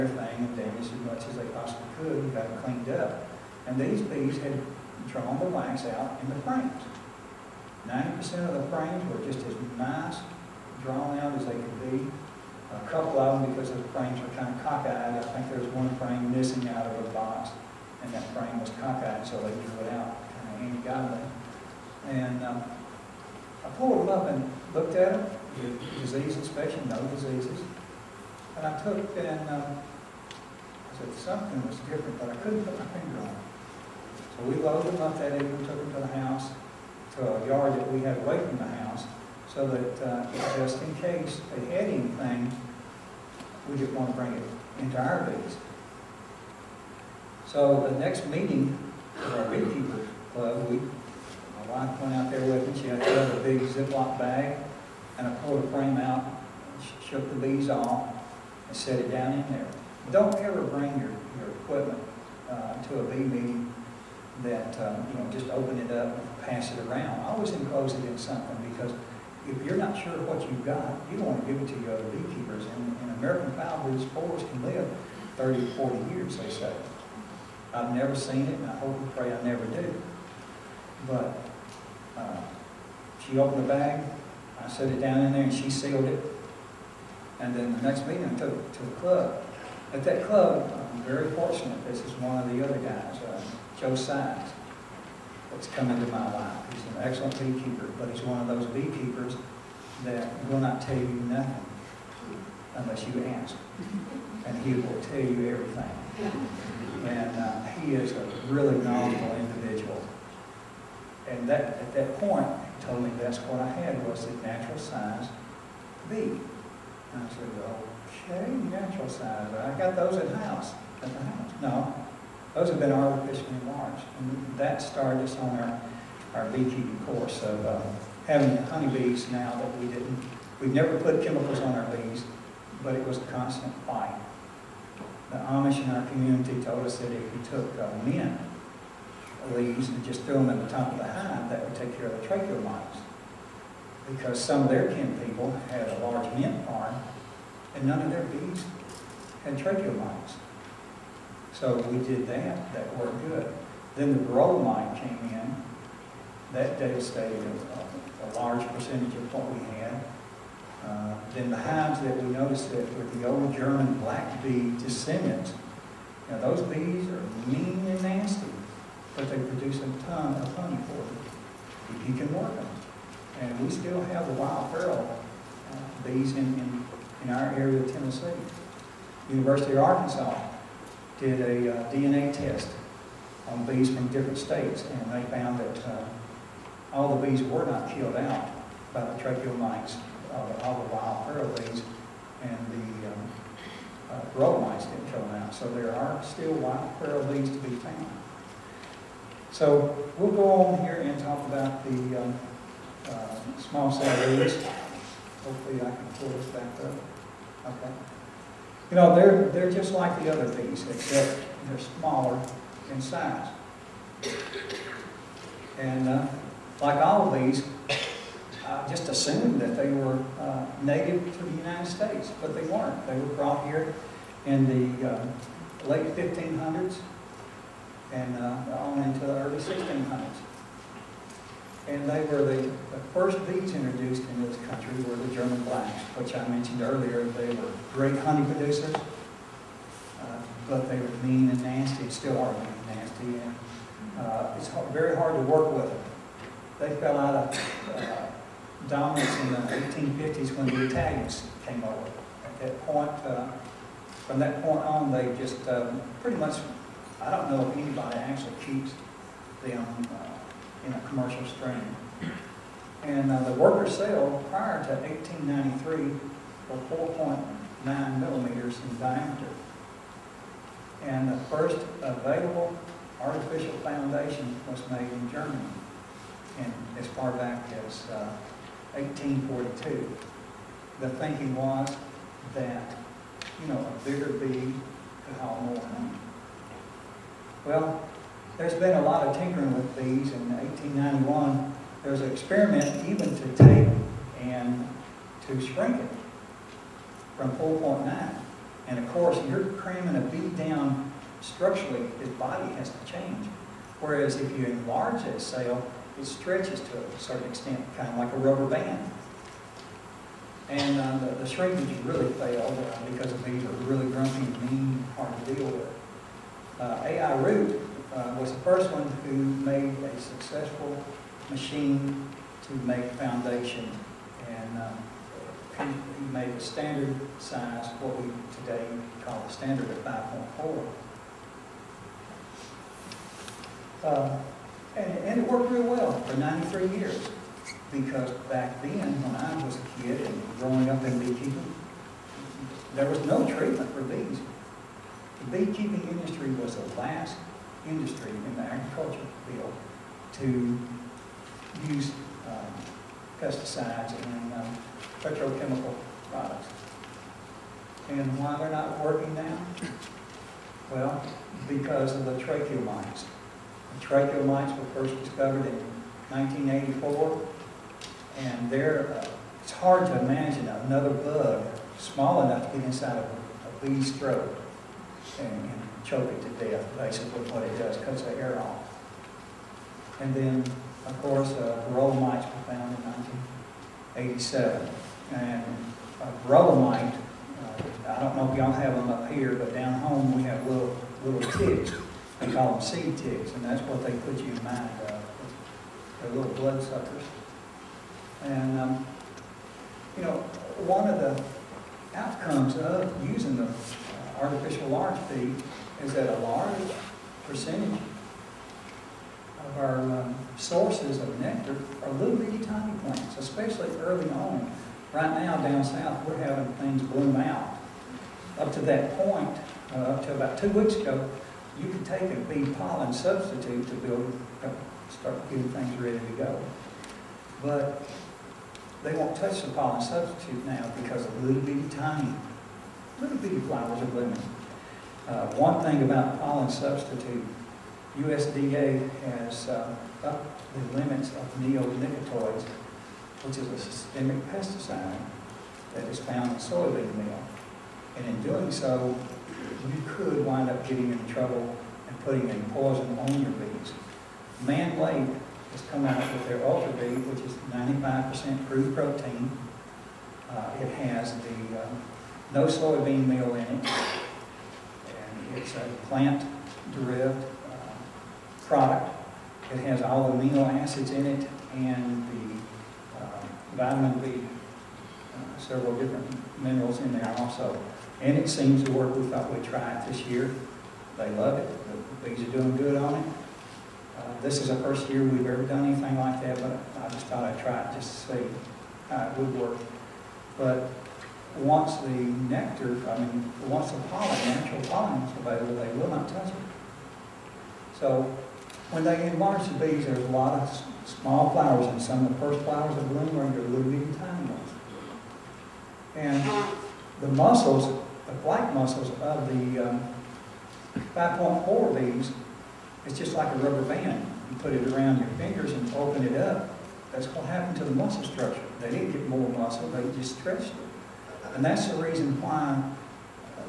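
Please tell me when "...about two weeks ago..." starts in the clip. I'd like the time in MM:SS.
07:00.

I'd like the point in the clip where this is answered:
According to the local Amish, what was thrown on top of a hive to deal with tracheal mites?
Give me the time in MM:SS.
02:18.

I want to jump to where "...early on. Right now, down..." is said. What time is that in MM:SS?
06:54.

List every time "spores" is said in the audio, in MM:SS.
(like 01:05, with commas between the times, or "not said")
01:14.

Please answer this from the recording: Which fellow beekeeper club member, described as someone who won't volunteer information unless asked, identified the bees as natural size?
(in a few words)
Joe Sines.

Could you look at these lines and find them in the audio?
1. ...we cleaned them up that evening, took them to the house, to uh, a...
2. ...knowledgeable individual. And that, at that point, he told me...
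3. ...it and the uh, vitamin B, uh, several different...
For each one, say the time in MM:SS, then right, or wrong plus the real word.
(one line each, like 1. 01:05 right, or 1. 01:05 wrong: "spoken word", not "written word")
1. 00:34 wrong: "loaded", not "cleaned"
2. 01:48 right
3. 07:51 right.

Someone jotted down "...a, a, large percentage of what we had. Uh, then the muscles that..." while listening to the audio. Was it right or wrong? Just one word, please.
wrong.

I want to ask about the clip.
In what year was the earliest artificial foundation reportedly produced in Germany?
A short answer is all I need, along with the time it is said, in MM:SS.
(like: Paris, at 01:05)
1842, at 04:38.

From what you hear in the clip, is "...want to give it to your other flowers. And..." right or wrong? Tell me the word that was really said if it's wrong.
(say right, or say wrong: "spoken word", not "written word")
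wrong: "beekeepers", not "flowers".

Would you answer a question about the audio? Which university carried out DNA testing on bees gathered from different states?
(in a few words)
University of Arkansas.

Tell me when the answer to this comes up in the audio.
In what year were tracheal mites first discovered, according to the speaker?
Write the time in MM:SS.
06:06.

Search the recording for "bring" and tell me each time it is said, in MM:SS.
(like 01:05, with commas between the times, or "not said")
00:44, 01:00.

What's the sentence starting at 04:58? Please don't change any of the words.
And of course, you're cramming a bee down structurally, his body has to change.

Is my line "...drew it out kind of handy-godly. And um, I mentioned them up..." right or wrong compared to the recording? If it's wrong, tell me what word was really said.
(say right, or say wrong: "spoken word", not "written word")
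wrong: "pulled", not "mentioned".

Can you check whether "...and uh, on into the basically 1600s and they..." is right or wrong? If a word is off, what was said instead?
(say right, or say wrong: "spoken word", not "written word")
wrong: "early", not "basically".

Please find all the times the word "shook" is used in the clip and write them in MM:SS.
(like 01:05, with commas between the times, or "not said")
00:57.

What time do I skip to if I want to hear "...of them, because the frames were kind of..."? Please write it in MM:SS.
00:13.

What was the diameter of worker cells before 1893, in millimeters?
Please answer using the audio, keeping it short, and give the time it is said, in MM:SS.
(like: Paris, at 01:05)
4.9, at 04:27.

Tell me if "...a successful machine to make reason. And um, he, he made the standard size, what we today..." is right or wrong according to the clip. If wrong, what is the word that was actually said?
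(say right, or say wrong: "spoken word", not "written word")
wrong: "foundation", not "reason".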